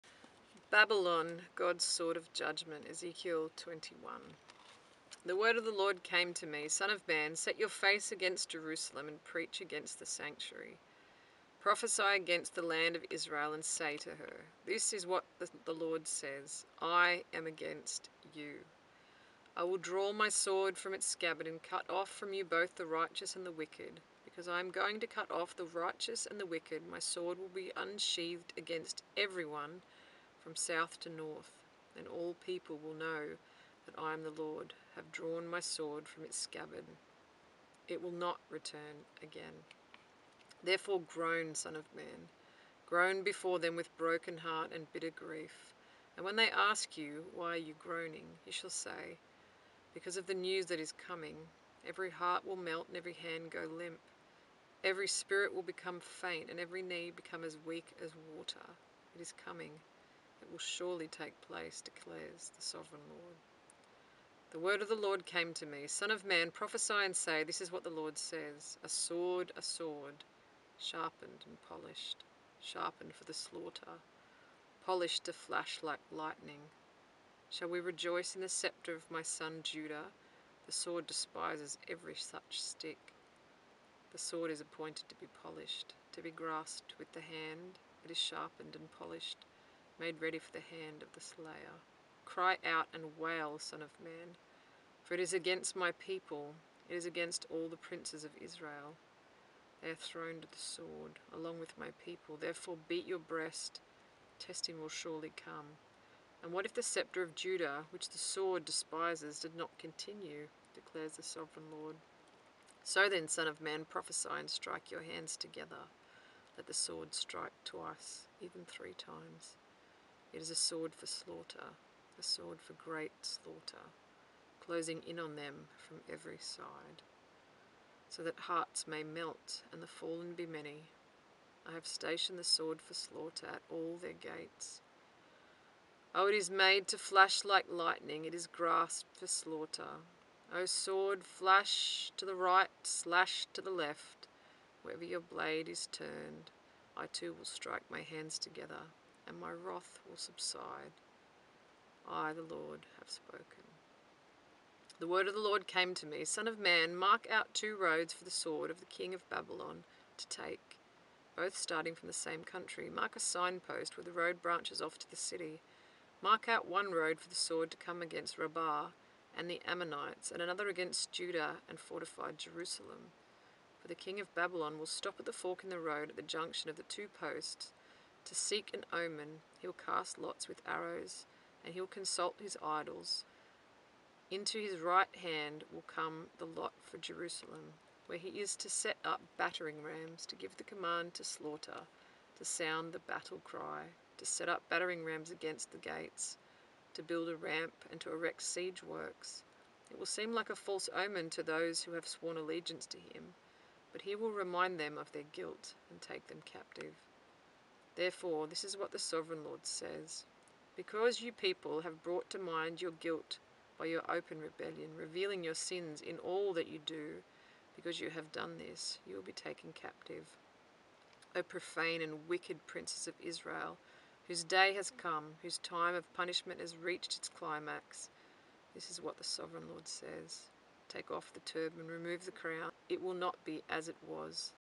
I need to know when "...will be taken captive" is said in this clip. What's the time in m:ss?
3:39.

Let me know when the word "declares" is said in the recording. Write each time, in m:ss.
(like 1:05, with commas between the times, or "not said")
1:01, 1:50.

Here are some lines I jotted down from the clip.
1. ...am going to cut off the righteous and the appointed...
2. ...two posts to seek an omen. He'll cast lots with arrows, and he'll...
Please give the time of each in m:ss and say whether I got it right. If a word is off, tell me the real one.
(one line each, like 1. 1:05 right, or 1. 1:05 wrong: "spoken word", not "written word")
1. 0:24 wrong: "wicked", not "appointed"
2. 2:56 right.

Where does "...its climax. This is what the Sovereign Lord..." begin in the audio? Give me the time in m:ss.
3:47.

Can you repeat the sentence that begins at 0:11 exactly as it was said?
Prophesy against the land of Israel and say to her, This is what the, Lord says I am against you.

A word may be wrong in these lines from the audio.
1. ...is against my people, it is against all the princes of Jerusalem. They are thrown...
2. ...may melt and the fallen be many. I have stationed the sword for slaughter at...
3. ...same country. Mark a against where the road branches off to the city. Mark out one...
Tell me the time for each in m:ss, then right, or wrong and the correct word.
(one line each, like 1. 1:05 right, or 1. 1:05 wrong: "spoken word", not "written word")
1. 1:35 wrong: "Israel", not "Jerusalem"
2. 2:08 right
3. 2:42 wrong: "signpost", not "against".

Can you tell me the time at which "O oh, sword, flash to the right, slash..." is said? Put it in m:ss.
2:20.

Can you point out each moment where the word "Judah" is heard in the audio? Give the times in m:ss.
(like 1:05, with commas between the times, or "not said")
1:19, 1:47, 2:51.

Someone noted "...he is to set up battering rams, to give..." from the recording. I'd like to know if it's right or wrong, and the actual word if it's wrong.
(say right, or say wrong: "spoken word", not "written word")
right.